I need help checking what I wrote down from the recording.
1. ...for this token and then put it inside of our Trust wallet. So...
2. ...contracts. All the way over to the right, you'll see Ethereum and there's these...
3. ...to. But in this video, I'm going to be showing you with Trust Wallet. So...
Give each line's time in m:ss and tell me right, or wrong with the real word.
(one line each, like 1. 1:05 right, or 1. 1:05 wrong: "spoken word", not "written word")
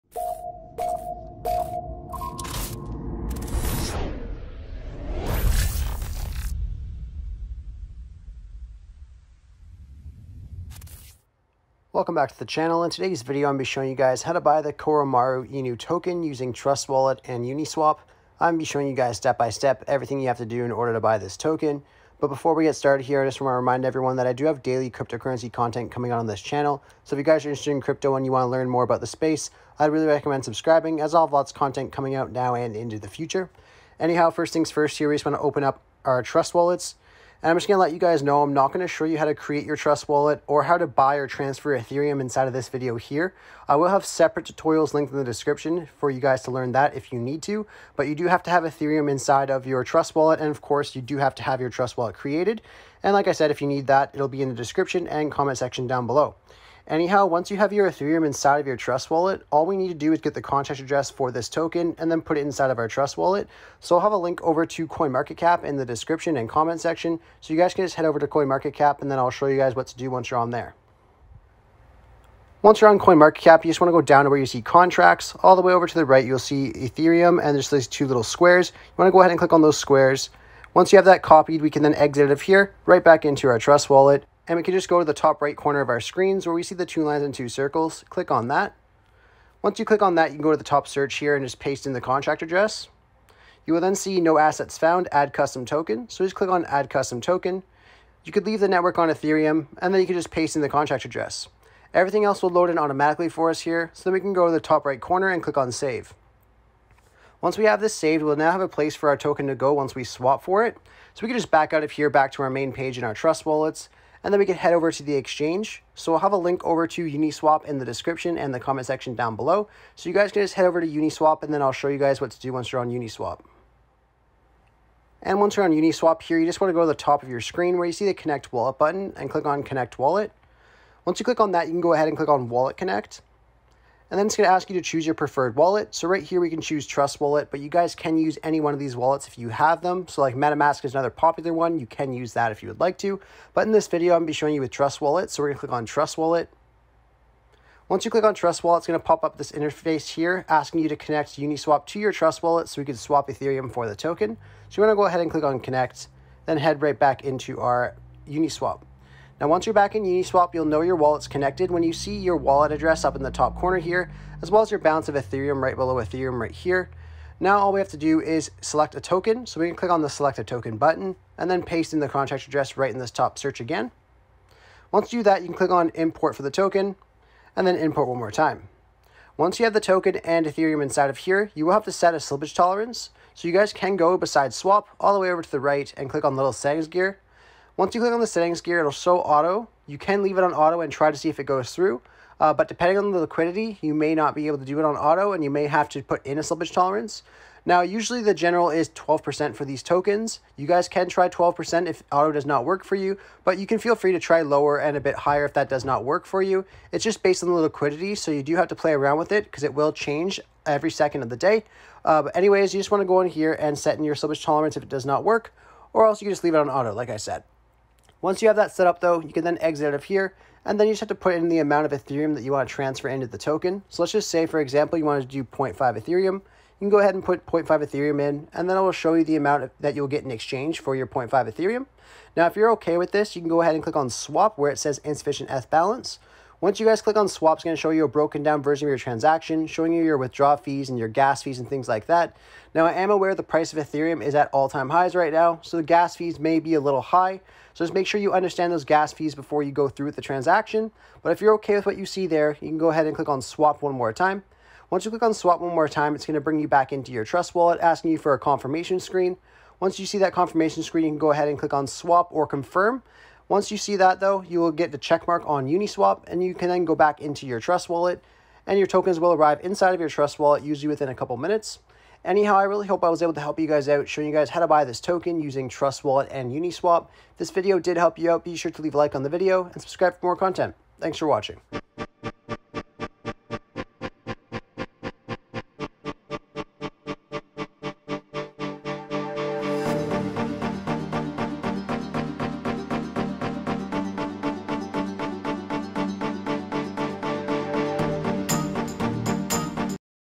1. 1:01 right
2. 1:14 right
3. 2:22 right.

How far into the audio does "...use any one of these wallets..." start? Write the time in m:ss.
2:18.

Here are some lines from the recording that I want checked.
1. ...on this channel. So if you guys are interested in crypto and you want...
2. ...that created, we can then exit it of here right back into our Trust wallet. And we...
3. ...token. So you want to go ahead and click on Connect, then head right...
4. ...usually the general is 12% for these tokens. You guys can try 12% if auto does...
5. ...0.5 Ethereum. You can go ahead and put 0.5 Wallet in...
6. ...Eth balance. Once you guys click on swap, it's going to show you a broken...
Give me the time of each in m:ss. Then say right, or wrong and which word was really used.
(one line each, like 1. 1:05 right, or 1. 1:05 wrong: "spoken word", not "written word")
1. 0:26 right
2. 1:21 wrong: "copied", not "created"
3. 2:33 right
4. 3:17 right
5. 3:45 wrong: "Ethereum", not "Wallet"
6. 3:55 right.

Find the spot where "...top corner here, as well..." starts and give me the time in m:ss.
2:43.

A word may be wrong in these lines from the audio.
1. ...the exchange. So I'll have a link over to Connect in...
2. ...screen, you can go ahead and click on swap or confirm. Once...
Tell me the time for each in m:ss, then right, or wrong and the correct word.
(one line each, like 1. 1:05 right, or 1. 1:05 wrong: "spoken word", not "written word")
1. 1:55 wrong: "Uniswap", not "Connect"
2. 4:20 right.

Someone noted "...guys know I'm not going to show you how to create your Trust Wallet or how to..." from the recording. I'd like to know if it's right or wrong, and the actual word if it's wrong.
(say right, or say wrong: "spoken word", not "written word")
right.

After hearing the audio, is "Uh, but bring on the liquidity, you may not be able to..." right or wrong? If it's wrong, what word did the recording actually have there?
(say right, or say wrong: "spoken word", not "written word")
wrong: "depending", not "bring".